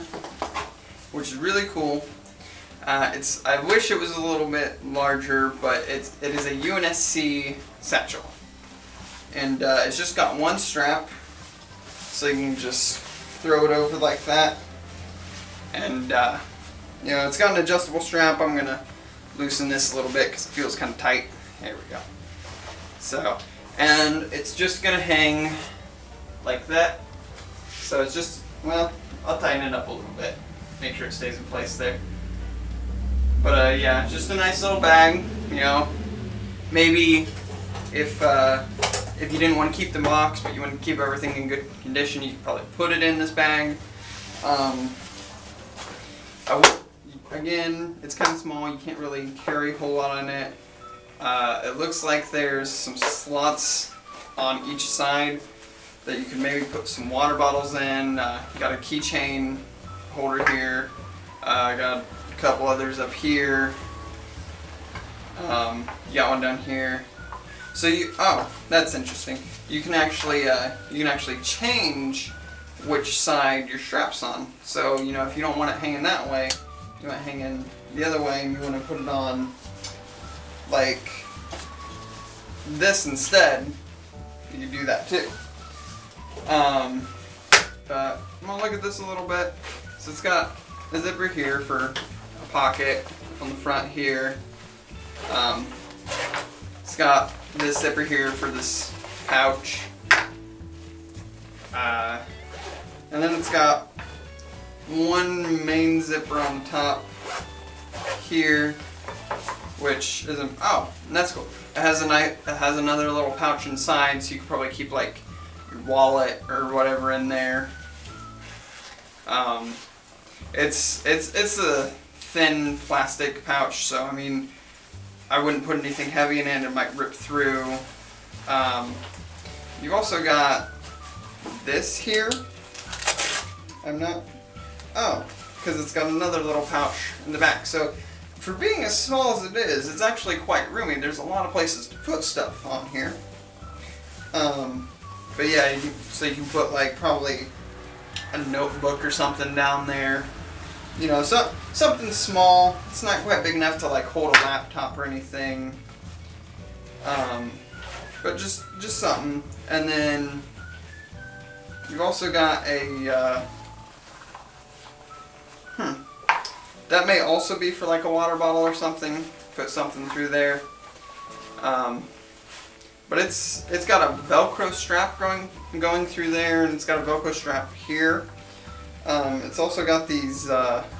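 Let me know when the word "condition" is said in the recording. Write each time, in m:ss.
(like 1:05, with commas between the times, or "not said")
0:41.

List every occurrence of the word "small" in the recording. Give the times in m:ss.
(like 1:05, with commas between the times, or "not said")
0:48, 2:18, 2:32.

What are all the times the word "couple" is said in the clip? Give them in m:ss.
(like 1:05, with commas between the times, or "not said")
1:02.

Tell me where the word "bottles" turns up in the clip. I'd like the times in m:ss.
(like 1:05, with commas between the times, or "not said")
0:57, 2:48.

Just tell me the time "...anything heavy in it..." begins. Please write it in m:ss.
2:05.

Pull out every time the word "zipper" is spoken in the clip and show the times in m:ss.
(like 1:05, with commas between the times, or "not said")
1:30, 1:37, 1:46.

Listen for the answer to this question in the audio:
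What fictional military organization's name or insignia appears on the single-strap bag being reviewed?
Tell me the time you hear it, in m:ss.
0:06.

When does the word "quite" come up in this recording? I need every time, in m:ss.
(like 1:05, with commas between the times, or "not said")
2:20, 2:33.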